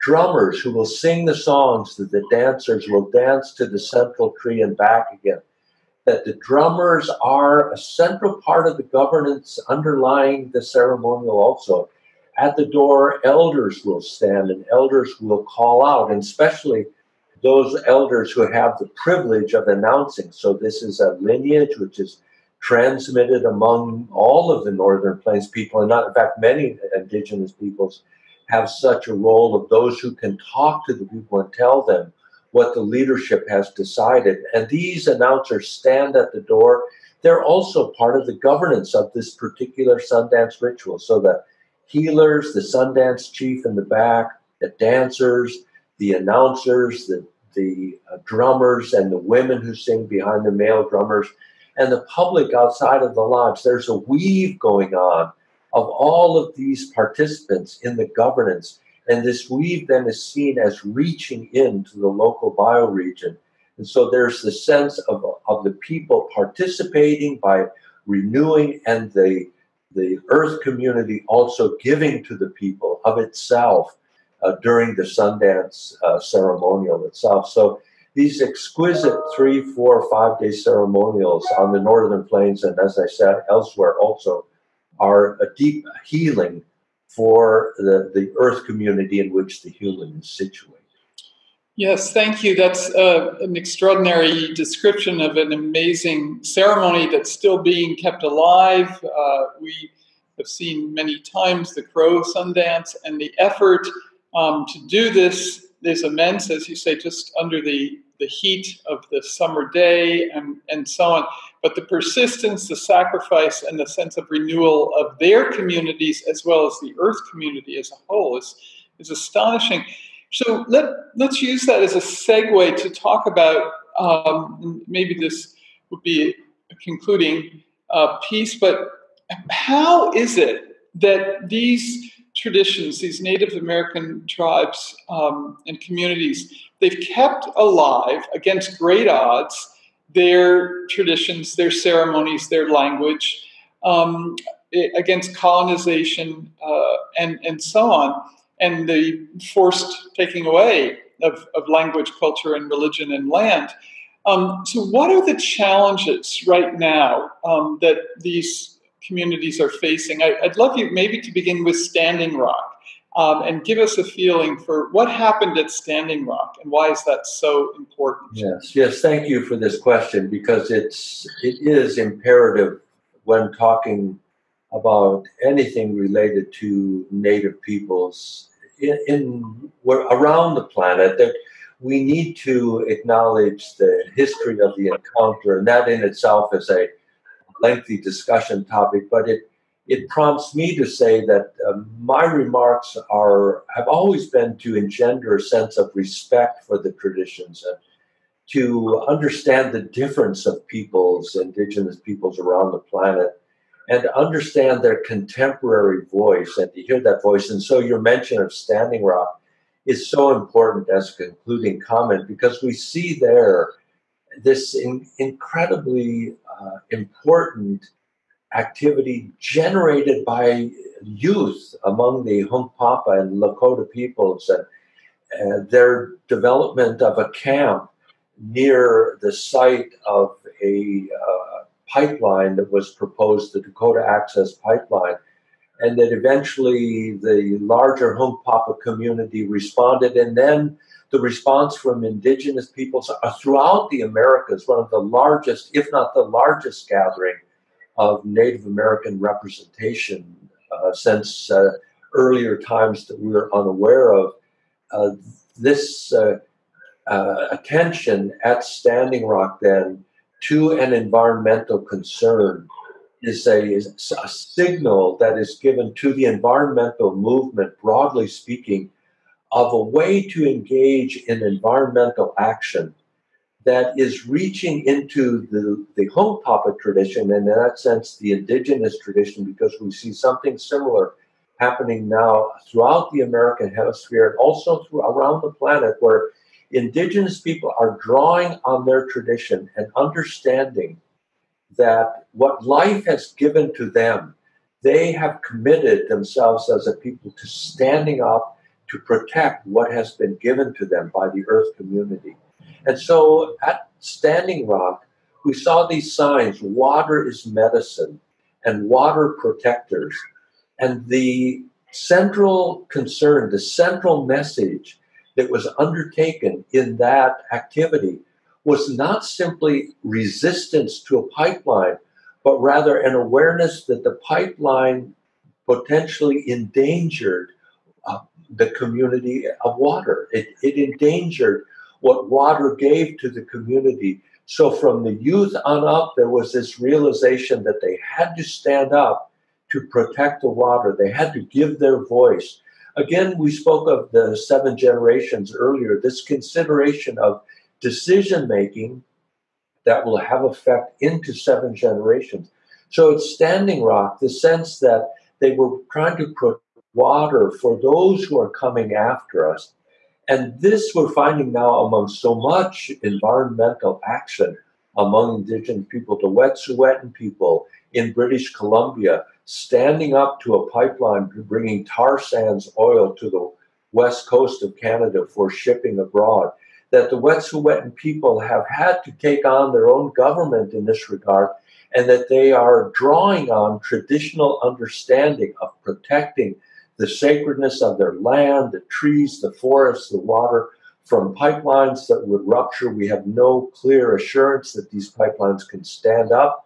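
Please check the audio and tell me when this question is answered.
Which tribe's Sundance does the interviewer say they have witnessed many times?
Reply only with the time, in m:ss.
1:41.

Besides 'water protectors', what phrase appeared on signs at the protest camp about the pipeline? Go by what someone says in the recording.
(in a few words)
Water is medicine.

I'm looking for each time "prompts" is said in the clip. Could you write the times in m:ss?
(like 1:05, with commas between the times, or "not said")
3:10.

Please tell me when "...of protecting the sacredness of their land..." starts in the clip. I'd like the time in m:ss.
6:25.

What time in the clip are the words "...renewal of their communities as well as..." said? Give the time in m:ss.
1:54.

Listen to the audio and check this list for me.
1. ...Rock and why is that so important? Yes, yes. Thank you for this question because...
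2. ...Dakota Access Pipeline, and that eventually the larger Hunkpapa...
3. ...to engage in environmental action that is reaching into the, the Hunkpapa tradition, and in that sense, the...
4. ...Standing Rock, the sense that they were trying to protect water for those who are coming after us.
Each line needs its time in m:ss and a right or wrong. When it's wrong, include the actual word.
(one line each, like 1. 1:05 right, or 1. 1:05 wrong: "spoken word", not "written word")
1. 2:46 right
2. 3:53 right
3. 4:30 right
4. 5:53 right.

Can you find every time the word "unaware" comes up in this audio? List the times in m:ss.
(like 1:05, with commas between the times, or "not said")
4:13.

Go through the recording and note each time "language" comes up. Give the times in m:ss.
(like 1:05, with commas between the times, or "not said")
2:22, 2:31.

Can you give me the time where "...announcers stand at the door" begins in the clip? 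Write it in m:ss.
0:35.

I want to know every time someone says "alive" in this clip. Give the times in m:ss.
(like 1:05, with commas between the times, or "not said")
1:38, 2:17.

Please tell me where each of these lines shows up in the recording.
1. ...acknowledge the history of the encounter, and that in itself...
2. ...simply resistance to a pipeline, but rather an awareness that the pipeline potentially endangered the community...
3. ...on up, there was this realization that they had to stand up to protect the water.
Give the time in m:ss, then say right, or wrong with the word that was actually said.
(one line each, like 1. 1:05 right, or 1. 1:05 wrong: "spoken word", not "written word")
1. 3:02 right
2. 5:19 right
3. 5:35 right.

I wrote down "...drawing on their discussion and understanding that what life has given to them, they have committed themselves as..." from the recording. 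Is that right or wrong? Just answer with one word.
wrong.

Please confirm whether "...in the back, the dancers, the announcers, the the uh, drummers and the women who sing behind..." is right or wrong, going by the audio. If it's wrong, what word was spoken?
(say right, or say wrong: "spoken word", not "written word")
right.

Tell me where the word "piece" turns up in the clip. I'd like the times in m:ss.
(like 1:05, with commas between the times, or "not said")
2:08.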